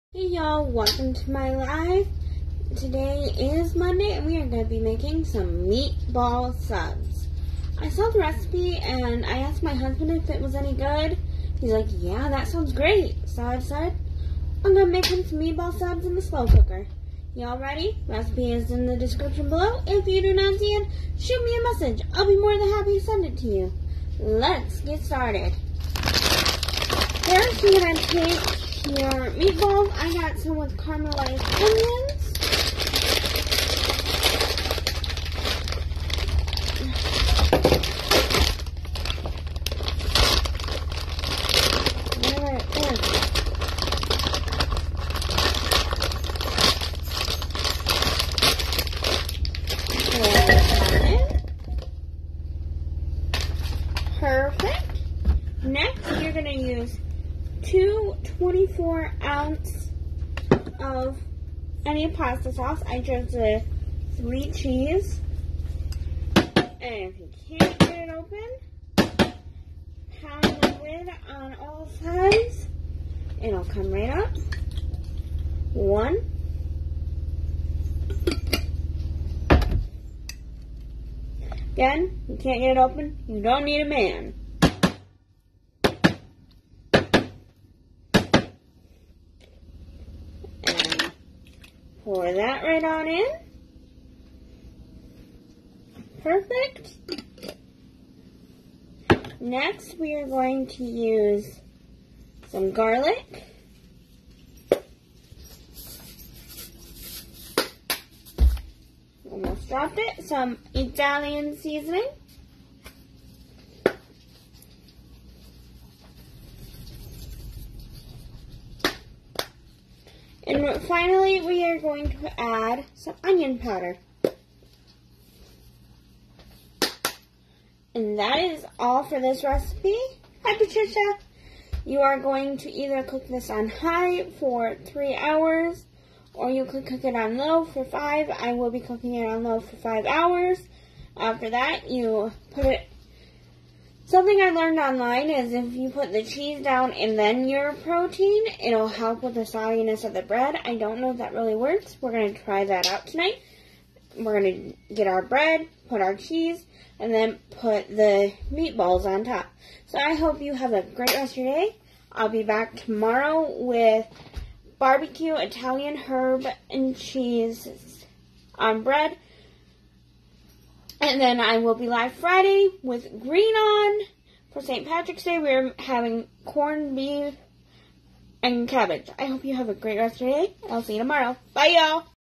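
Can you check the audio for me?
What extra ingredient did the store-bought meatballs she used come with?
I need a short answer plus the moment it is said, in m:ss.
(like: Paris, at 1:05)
caramelized onions, at 0:30.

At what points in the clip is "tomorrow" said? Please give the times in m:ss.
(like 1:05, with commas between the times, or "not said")
2:42, 3:00.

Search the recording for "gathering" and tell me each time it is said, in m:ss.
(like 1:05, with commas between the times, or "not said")
not said.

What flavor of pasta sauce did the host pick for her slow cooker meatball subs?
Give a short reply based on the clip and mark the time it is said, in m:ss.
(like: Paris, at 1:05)
three cheese, at 1:04.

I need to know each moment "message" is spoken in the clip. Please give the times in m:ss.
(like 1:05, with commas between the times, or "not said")
0:21.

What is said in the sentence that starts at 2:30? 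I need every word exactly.
I don't know if that really works.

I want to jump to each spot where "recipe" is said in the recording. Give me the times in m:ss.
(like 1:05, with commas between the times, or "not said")
0:08, 0:18, 2:09.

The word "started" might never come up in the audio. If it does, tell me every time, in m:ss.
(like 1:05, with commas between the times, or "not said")
0:25.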